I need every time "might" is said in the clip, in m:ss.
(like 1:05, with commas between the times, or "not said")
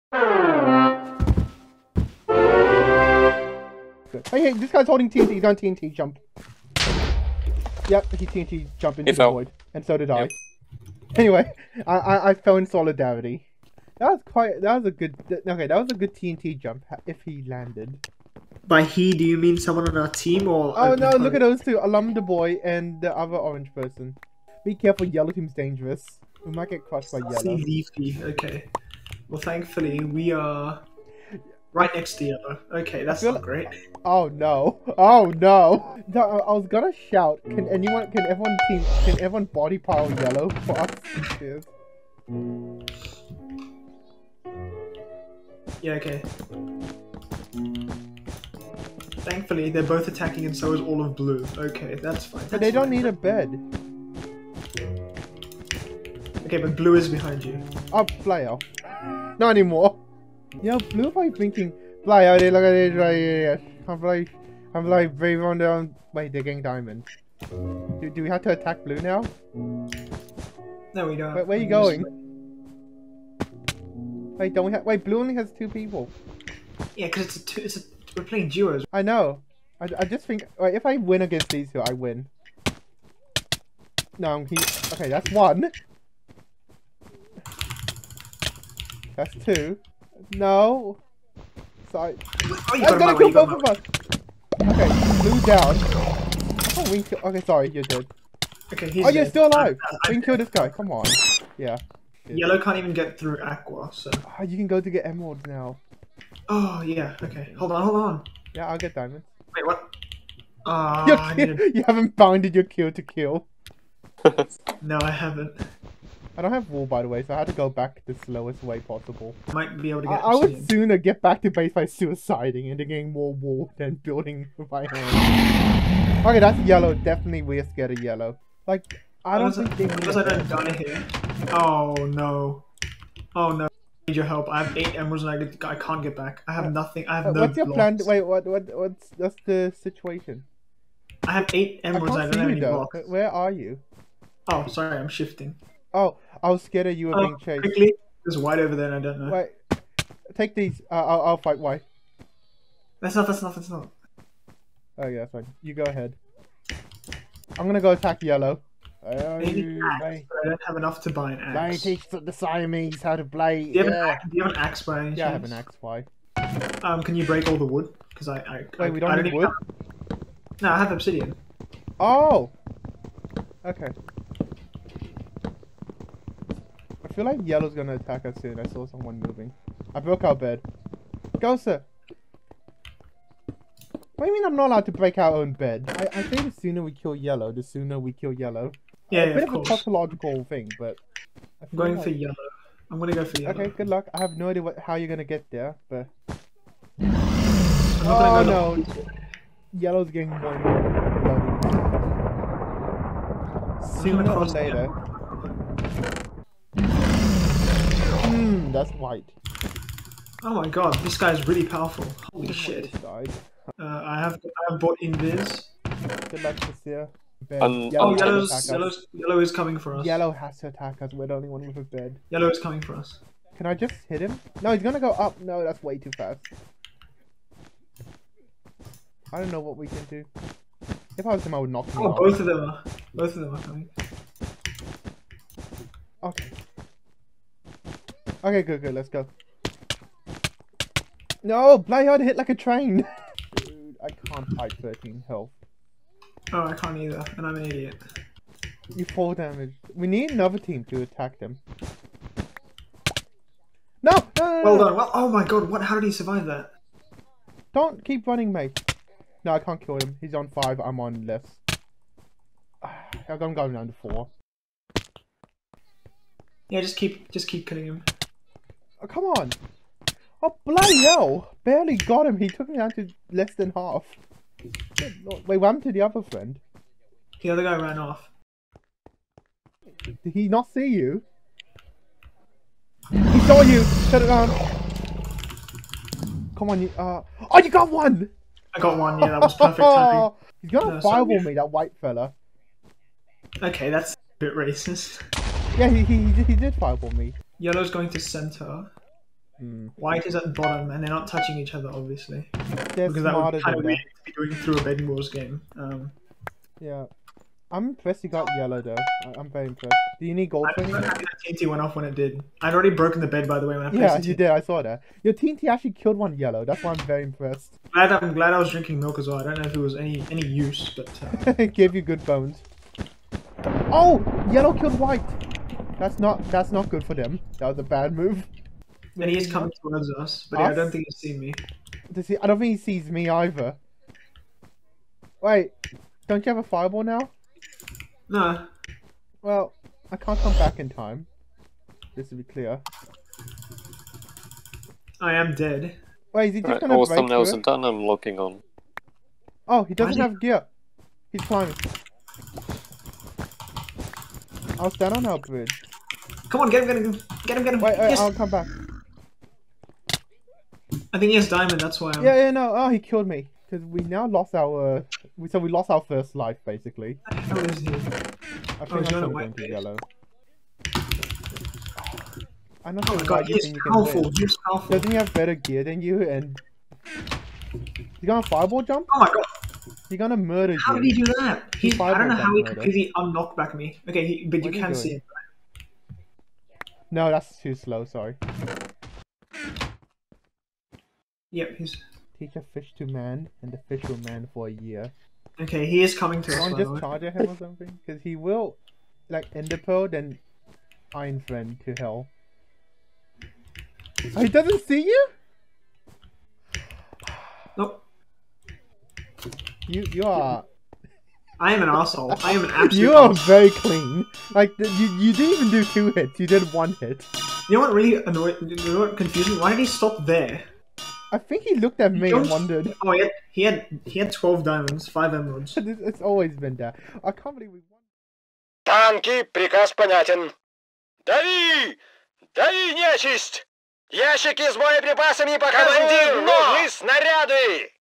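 0:26, 1:59.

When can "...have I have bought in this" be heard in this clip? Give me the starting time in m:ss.
3:34.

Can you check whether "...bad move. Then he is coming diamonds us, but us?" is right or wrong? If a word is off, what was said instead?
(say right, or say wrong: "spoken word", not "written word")
wrong: "towards", not "diamonds".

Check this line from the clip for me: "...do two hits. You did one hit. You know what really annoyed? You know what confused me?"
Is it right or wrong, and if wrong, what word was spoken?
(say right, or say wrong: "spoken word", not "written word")
right.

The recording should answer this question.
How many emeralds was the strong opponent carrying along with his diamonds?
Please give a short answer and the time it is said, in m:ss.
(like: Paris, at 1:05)
5, at 7:05.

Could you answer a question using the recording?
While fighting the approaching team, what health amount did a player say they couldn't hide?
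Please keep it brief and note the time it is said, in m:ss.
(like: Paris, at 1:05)
13, at 4:04.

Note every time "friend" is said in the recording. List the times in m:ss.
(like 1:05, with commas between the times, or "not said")
4:36, 6:41.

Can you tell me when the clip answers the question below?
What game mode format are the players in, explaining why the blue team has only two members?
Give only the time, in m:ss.
1:18.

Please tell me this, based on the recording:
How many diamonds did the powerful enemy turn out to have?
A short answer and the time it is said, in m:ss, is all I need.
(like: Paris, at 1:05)
12, at 7:04.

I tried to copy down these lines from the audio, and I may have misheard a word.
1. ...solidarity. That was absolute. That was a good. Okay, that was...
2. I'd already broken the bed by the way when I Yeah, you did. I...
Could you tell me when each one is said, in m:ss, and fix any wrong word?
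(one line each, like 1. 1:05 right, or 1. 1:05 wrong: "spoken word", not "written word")
1. 0:12 wrong: "quite", not "absolute"
2. 5:12 right.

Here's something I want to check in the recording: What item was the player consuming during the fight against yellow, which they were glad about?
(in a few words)
Milk.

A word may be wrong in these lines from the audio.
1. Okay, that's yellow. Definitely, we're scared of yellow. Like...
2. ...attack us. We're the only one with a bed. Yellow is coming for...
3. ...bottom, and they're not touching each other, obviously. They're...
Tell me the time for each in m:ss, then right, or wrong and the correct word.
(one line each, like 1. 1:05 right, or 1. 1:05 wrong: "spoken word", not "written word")
1. 2:06 right
2. 3:40 right
3. 5:00 right.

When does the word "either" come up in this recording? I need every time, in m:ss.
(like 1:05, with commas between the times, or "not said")
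4:06, 5:33.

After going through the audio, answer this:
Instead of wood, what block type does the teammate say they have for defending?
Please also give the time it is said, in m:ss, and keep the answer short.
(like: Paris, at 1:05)
Obsidian, at 2:50.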